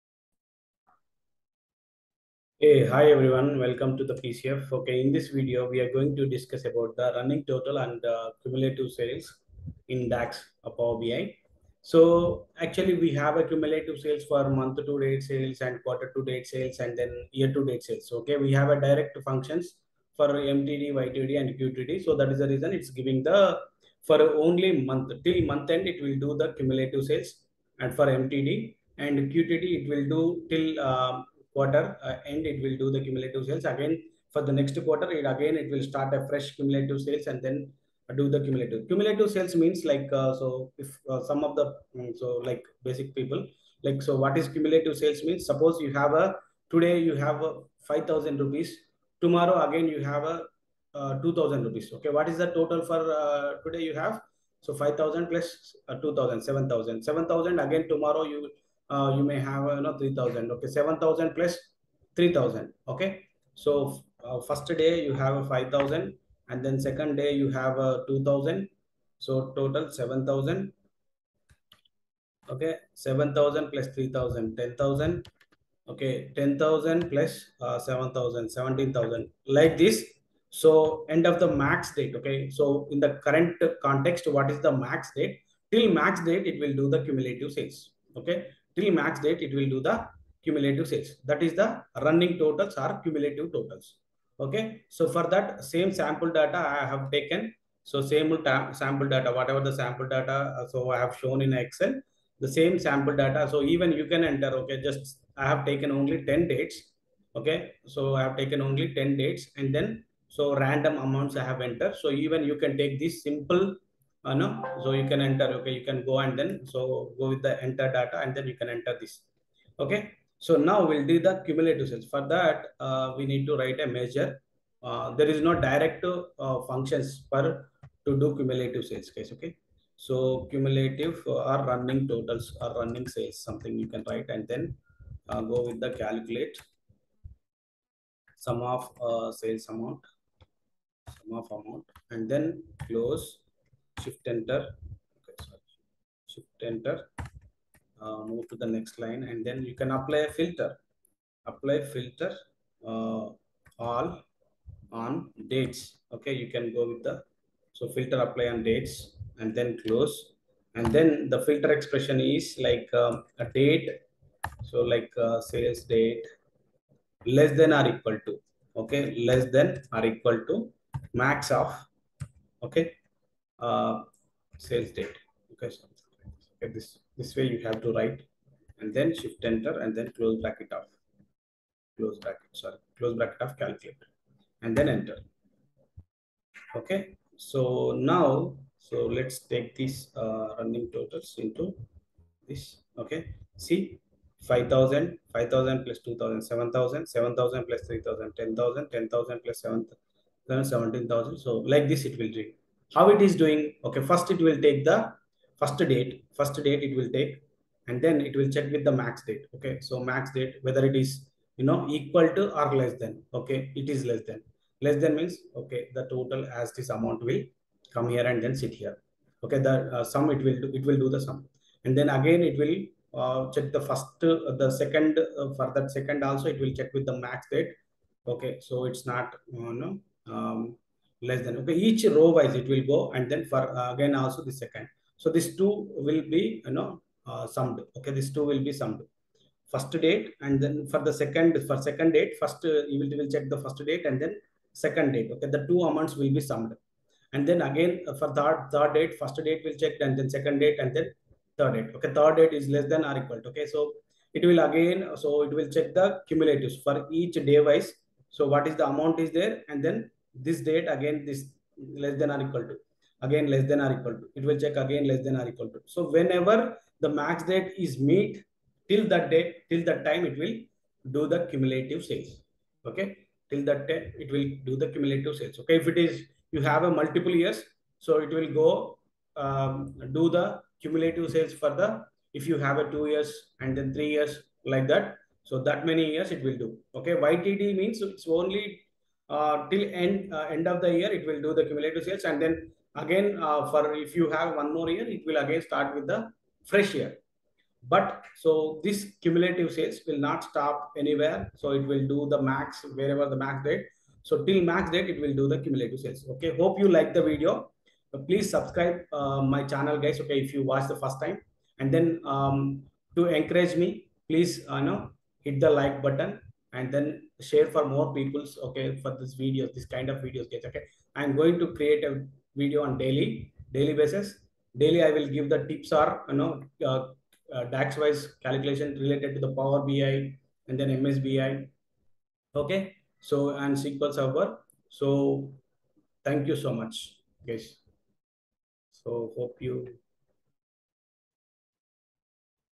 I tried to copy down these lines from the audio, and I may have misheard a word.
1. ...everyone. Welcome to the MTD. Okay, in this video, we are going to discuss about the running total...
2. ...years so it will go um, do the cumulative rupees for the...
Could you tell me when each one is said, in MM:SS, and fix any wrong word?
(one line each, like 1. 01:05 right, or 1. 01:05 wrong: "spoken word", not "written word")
1. 00:03 wrong: "PCF", not "MTD"
2. 04:37 wrong: "sales", not "rupees".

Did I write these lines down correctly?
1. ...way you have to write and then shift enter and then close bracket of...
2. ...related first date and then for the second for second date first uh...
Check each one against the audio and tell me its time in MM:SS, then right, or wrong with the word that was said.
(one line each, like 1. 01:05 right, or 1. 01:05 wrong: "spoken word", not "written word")
1. 02:57 right
2. 03:58 wrong: "summed", not "related".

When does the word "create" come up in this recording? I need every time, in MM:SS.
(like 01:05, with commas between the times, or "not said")
05:21.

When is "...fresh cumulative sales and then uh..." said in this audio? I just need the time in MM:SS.
00:36.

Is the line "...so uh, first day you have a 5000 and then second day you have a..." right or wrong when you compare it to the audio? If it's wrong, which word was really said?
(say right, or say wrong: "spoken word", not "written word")
right.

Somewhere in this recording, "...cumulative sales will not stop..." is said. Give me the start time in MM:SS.
04:59.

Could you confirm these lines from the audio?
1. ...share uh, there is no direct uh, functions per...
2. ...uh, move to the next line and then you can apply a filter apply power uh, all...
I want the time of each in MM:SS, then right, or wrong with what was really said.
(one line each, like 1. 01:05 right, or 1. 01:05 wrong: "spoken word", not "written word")
1. 02:03 wrong: "measure", not "share"
2. 02:28 wrong: "filter", not "power".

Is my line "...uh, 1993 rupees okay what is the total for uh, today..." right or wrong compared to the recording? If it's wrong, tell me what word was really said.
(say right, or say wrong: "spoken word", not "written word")
wrong: "2000", not "1993".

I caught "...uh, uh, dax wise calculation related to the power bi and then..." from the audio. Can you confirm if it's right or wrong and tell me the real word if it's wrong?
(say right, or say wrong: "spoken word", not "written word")
right.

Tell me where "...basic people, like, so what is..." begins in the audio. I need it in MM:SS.
00:42.